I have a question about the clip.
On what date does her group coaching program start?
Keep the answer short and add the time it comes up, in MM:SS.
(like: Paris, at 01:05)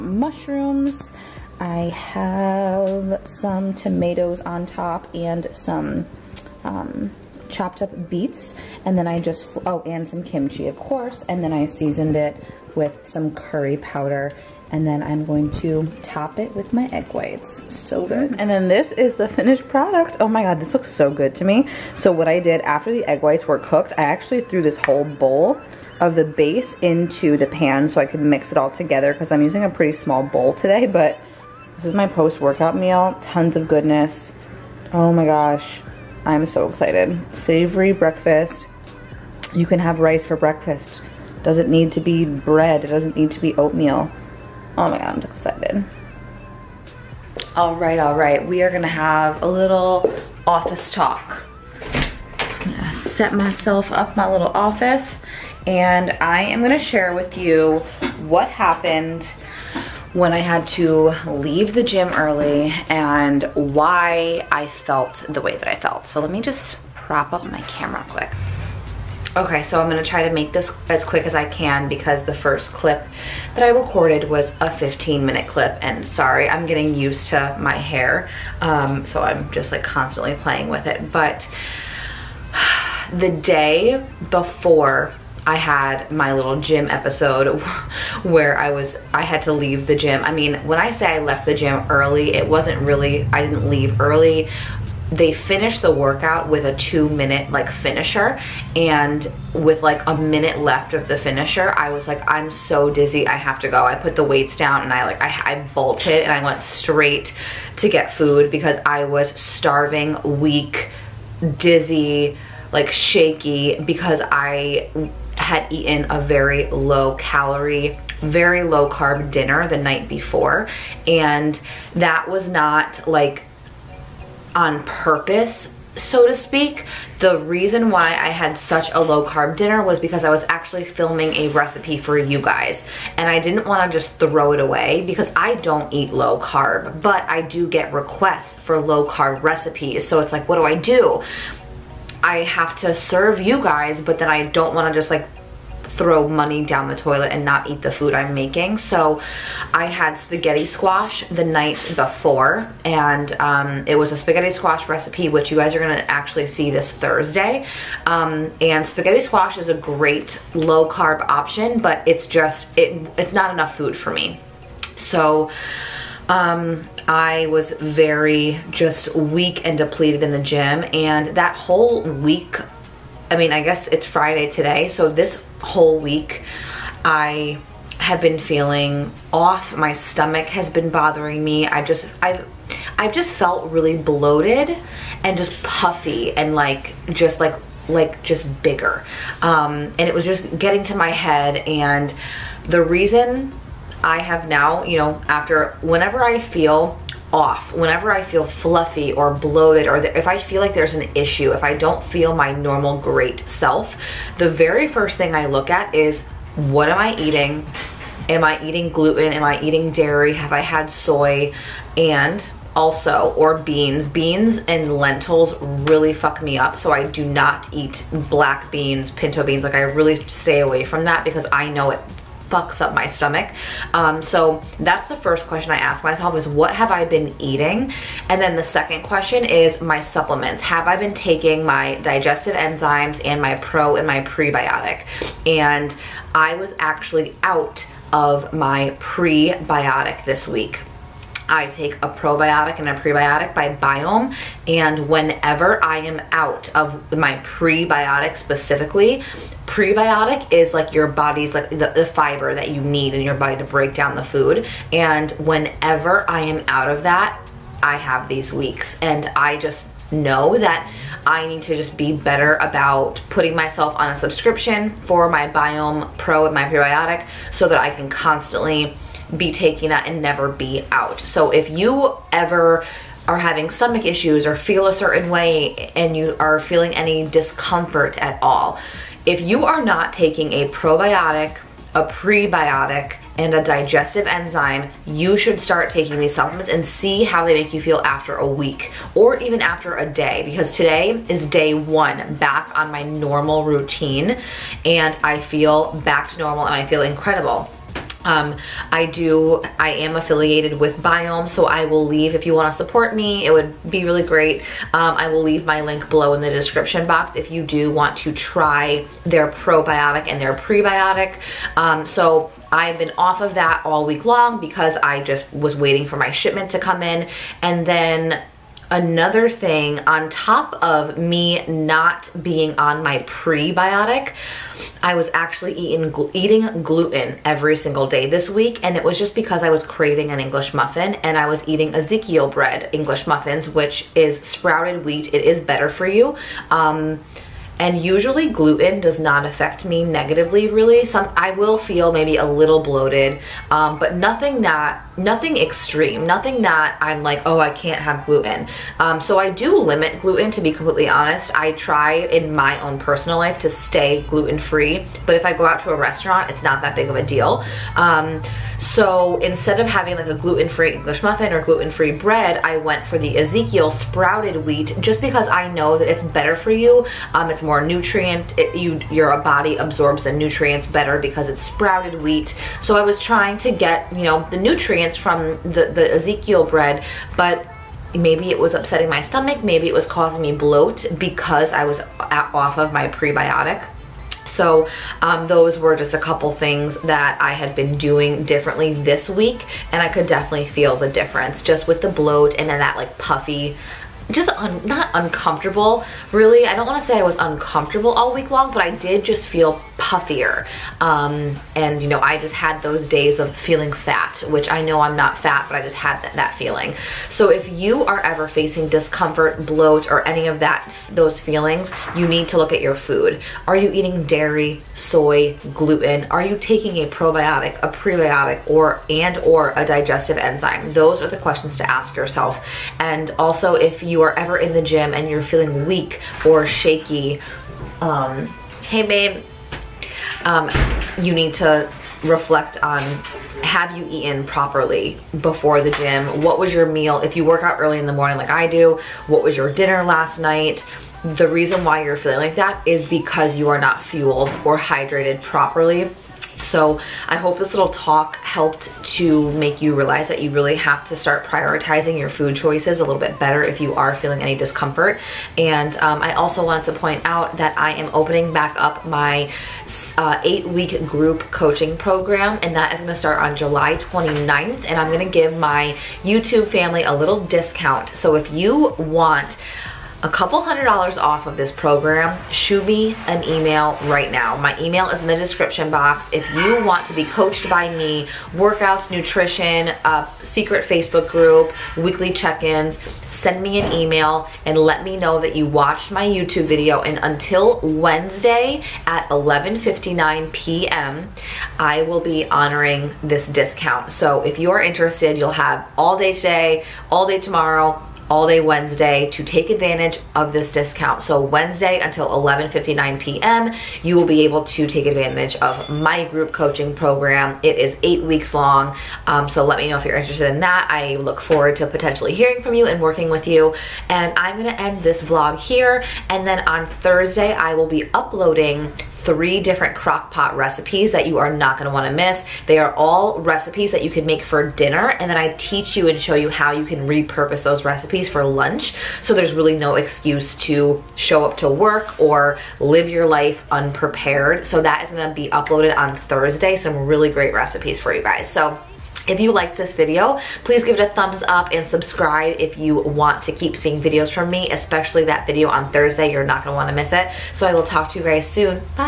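July 29th, at 07:43.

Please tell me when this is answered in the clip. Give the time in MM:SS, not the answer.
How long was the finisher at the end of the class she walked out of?
01:36.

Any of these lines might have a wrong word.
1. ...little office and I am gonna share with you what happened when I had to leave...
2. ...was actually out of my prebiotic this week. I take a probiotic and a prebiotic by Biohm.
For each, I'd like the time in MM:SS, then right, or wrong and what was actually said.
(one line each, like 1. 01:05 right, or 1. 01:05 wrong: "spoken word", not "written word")
1. 00:54 right
2. 03:56 right.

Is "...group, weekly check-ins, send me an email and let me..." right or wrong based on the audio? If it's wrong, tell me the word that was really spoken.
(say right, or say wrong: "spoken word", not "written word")
right.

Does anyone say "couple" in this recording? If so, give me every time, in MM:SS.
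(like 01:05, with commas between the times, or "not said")
06:26, 07:50.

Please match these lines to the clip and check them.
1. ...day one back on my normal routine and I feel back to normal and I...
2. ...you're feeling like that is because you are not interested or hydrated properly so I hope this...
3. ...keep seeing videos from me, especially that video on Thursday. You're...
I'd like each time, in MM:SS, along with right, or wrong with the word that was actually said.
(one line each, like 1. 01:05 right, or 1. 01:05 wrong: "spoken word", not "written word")
1. 04:51 right
2. 07:22 wrong: "fueled", not "interested"
3. 09:03 right.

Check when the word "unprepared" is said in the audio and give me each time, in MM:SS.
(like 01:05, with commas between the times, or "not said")
08:53.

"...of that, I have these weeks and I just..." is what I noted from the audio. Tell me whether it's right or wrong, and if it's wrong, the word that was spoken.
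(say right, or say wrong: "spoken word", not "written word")
right.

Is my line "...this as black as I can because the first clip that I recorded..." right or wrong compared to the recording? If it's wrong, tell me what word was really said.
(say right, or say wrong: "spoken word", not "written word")
wrong: "quick", not "black".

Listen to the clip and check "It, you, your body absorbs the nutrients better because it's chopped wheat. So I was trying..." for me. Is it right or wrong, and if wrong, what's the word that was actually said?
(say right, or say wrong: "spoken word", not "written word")
wrong: "sprouted", not "chopped".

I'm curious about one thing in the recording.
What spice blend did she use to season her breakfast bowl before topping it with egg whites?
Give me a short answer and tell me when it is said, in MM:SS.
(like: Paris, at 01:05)
curry powder, at 00:13.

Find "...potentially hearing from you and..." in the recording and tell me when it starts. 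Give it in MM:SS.
08:31.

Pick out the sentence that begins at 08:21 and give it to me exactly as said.
So Wednesday until 11.59 p.m., you will be able to take advantage of my group coaching program.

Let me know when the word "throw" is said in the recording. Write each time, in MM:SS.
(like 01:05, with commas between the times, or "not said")
02:14, 02:25.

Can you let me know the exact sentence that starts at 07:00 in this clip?
Those are the questions to ask yourself.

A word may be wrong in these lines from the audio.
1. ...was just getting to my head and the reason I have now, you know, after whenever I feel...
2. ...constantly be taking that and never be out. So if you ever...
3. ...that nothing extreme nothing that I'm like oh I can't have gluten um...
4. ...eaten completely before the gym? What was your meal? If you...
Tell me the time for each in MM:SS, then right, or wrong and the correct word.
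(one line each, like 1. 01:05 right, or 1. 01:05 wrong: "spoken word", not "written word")
1. 03:10 right
2. 04:28 right
3. 05:44 right
4. 07:14 wrong: "properly", not "completely".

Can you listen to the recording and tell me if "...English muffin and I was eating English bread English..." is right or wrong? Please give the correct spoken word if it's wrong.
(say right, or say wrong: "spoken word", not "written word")
wrong: "Ezekiel", not "English".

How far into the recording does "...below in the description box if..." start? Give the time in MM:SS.
05:06.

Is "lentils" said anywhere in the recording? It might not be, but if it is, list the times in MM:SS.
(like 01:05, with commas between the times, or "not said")
03:34.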